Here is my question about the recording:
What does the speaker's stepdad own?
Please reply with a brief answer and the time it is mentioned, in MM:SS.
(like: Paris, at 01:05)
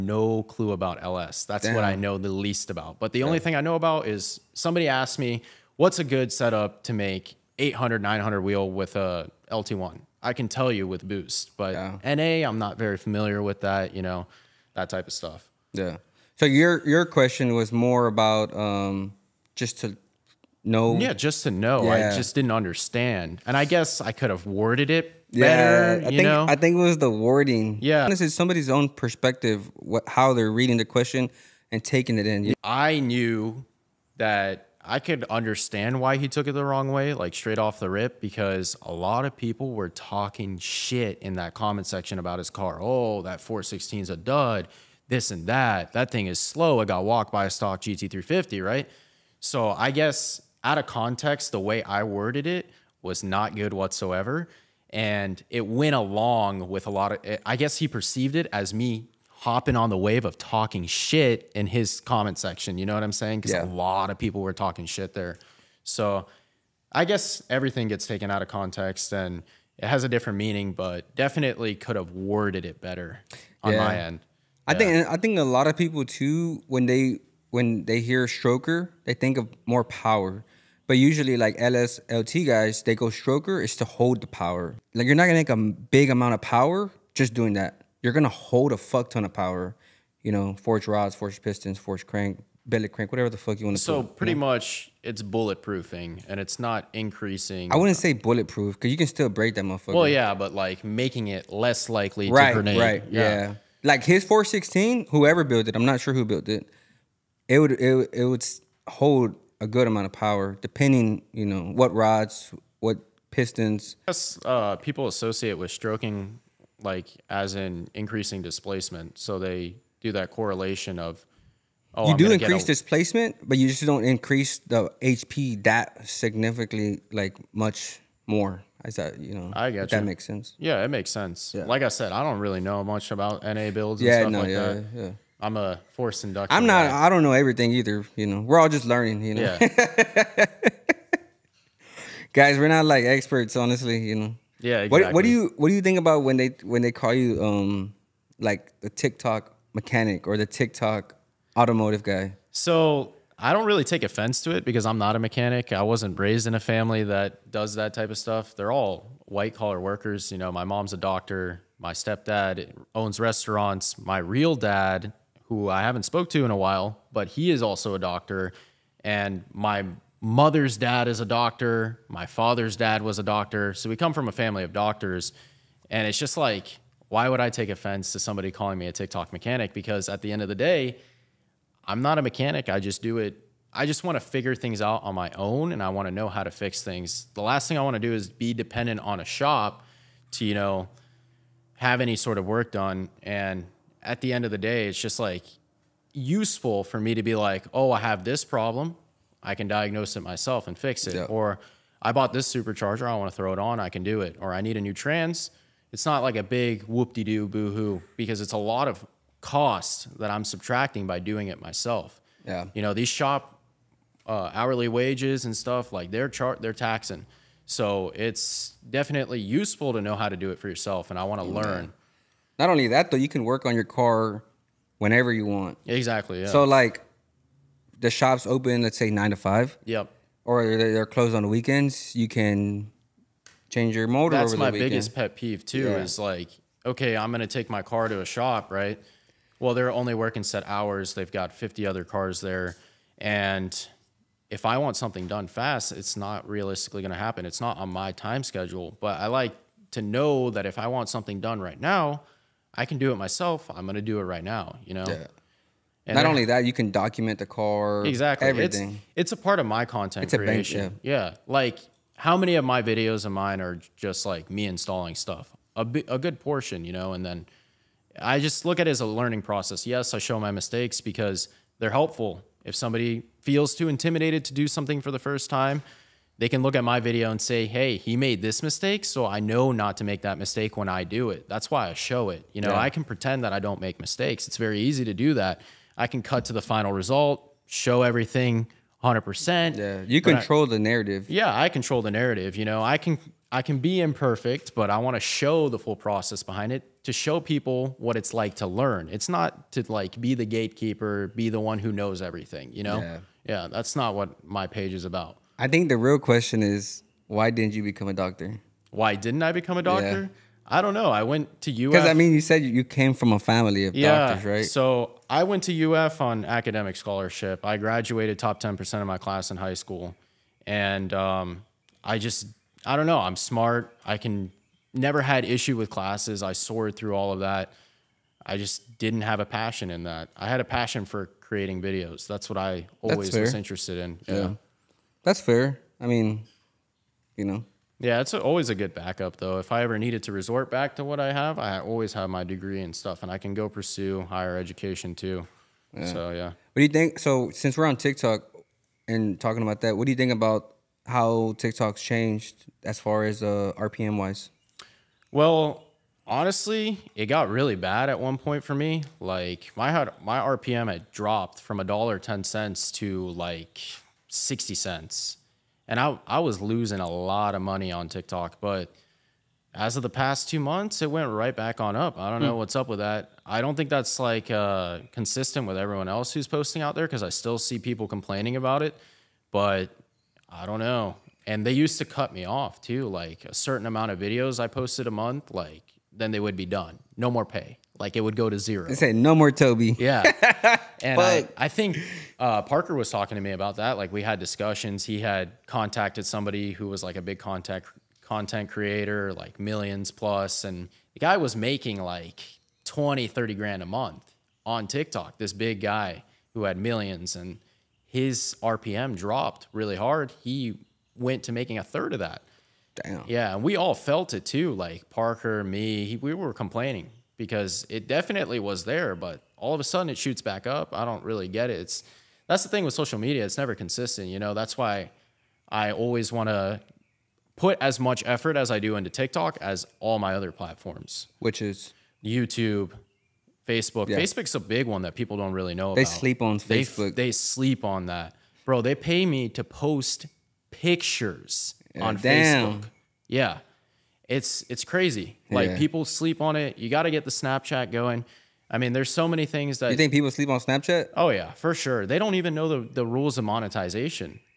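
Restaurants, at 02:43.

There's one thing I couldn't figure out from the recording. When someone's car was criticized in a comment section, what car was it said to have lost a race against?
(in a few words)
stock GT350.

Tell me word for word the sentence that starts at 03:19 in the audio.
I can diagnose it myself and fix it.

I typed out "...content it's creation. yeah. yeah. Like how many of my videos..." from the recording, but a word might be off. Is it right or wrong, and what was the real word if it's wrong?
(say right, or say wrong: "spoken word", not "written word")
right.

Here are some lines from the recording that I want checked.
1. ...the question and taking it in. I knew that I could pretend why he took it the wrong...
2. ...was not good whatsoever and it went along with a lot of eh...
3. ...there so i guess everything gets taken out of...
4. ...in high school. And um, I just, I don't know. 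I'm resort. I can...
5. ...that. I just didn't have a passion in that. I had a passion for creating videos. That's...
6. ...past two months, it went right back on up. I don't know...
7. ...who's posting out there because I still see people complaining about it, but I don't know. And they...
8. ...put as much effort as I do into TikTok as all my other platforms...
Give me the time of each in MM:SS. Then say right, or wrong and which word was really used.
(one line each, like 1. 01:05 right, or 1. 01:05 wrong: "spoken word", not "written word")
1. 00:30 wrong: "understand", not "pretend"
2. 00:53 right
3. 01:05 right
4. 05:19 wrong: "smart", not "resort"
5. 05:27 right
6. 06:10 right
7. 06:16 right
8. 07:07 right.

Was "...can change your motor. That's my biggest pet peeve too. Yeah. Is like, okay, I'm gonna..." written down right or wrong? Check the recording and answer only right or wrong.
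right.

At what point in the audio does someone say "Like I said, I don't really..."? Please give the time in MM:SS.
02:11.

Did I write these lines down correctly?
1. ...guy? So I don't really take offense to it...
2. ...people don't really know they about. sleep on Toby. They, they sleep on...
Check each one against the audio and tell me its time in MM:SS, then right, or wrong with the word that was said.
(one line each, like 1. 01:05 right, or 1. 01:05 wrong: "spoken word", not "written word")
1. 02:32 right
2. 07:15 wrong: "Facebook", not "Toby".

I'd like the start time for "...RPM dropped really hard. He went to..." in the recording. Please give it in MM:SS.
06:48.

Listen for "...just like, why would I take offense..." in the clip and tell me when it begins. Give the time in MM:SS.
02:56.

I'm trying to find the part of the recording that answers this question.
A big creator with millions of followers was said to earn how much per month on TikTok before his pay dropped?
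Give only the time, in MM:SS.
06:42.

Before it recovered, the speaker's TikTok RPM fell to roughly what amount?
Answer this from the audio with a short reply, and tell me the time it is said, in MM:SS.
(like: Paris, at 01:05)
60 cents, at 06:04.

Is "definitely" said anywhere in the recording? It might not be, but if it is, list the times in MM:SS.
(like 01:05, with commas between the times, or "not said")
01:11, 03:38, 06:58.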